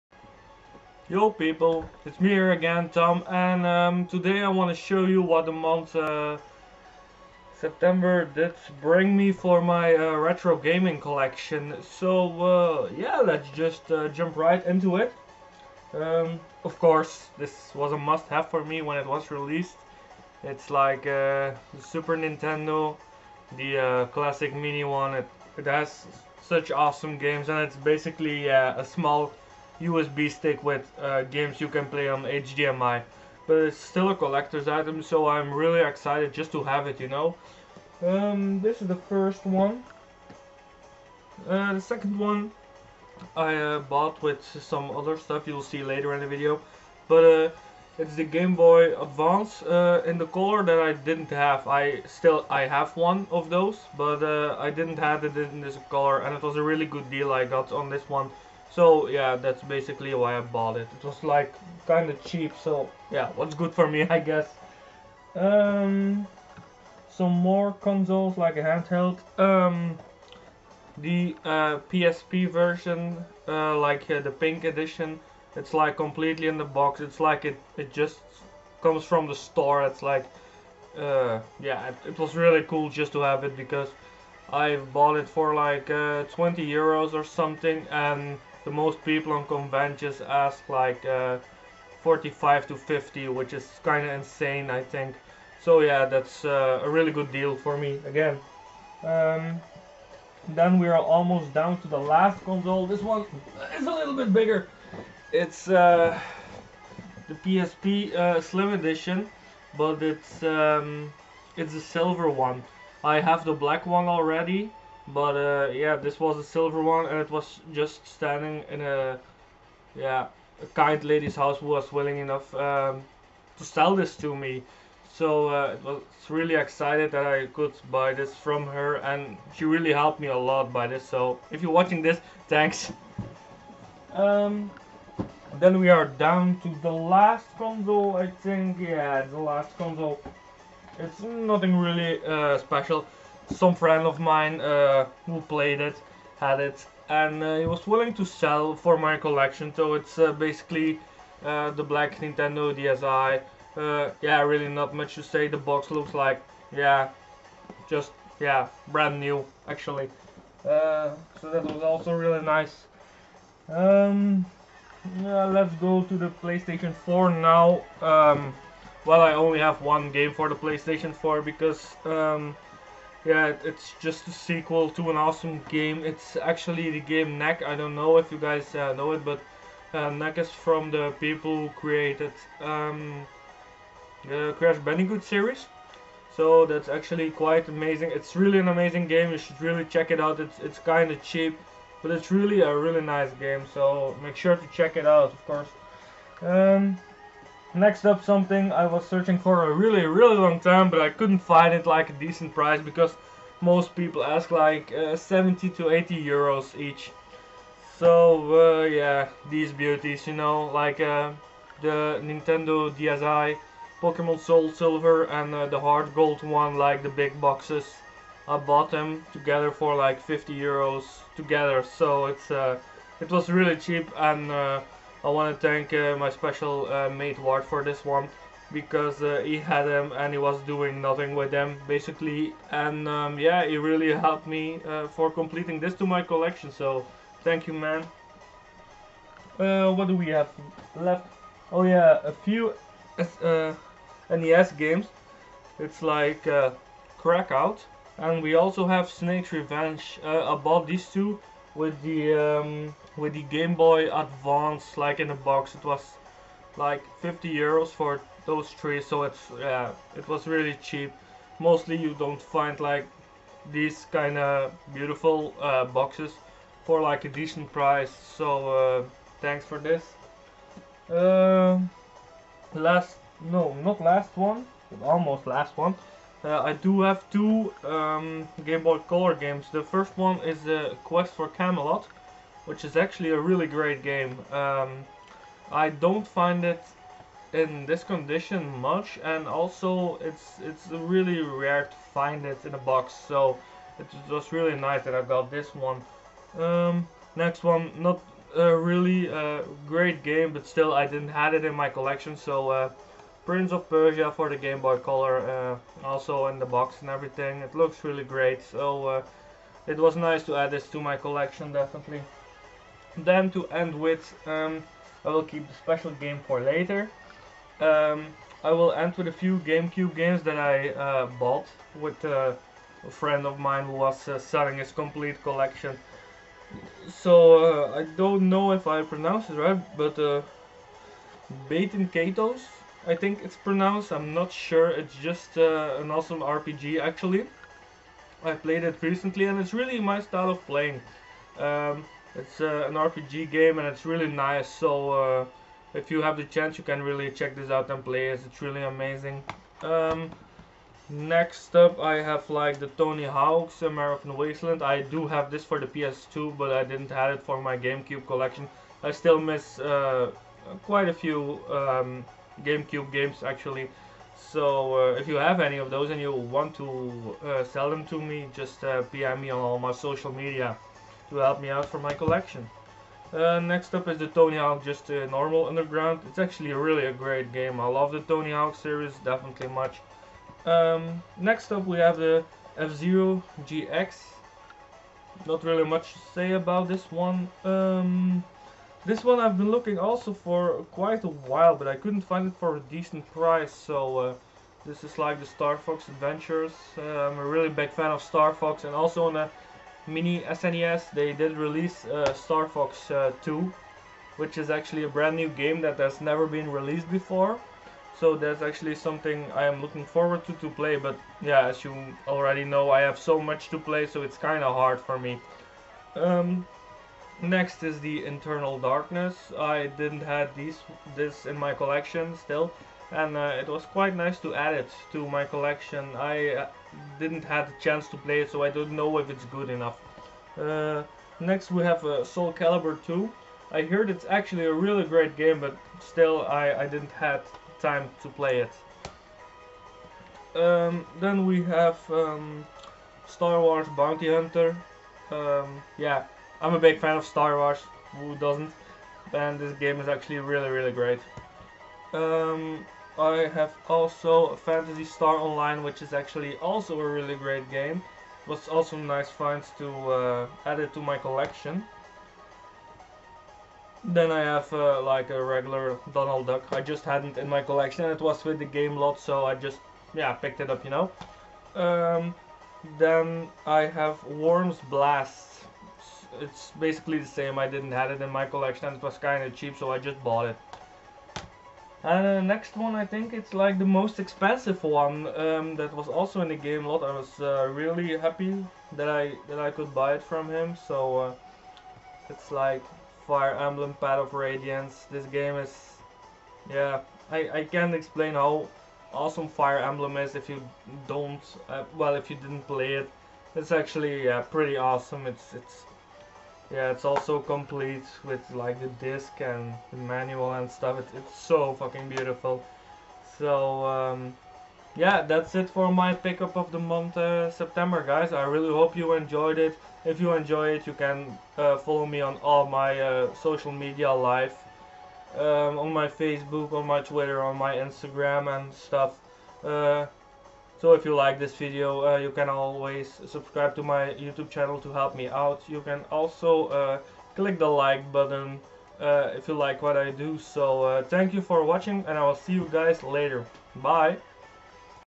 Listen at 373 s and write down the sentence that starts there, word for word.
Uh, next up is the Tony Hawk just uh, normal underground.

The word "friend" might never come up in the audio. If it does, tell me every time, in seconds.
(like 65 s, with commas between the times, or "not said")
143 s, 323 s.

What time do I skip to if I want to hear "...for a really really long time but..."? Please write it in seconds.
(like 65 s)
199 s.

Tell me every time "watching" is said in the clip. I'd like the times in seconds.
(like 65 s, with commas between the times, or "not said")
131 s, 541 s.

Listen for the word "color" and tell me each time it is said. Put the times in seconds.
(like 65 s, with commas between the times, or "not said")
50 s, 55 s, 278 s, 305 s.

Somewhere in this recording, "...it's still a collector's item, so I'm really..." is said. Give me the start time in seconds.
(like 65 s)
33 s.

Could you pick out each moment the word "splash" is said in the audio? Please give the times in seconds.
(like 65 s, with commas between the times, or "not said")
not said.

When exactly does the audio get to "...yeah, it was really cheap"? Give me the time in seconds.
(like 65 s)
259 s.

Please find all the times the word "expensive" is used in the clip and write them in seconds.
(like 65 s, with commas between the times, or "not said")
484 s.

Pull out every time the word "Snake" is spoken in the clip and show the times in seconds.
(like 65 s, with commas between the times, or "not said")
249 s.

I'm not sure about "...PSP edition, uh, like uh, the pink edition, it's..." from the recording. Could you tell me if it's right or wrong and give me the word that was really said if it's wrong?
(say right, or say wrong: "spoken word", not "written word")
wrong: "version", not "edition".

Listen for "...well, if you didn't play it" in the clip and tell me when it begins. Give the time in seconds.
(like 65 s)
501 s.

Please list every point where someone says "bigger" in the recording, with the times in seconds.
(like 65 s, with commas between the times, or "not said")
104 s.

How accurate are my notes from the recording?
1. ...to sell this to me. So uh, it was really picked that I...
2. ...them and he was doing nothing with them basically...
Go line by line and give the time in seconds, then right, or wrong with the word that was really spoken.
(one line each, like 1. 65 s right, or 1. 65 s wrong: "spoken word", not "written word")
1. 123 s wrong: "excited", not "picked"
2. 229 s right.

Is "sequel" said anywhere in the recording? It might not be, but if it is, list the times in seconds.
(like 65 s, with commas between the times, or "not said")
174 s.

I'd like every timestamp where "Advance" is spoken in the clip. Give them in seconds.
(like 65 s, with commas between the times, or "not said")
49 s, 254 s.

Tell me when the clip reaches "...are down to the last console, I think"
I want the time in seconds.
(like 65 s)
135 s.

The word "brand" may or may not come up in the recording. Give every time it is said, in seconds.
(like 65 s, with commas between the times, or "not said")
158 s, 405 s.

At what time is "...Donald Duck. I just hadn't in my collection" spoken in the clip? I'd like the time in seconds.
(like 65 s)
466 s.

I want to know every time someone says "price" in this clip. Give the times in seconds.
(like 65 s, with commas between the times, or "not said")
202 s, 267 s, 393 s.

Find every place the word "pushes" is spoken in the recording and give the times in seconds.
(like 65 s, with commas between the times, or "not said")
not said.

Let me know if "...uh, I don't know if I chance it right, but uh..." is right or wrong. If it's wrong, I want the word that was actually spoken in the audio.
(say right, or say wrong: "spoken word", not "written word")
wrong: "pronounce", not "chance".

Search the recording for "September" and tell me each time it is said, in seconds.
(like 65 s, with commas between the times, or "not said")
7 s, 517 s.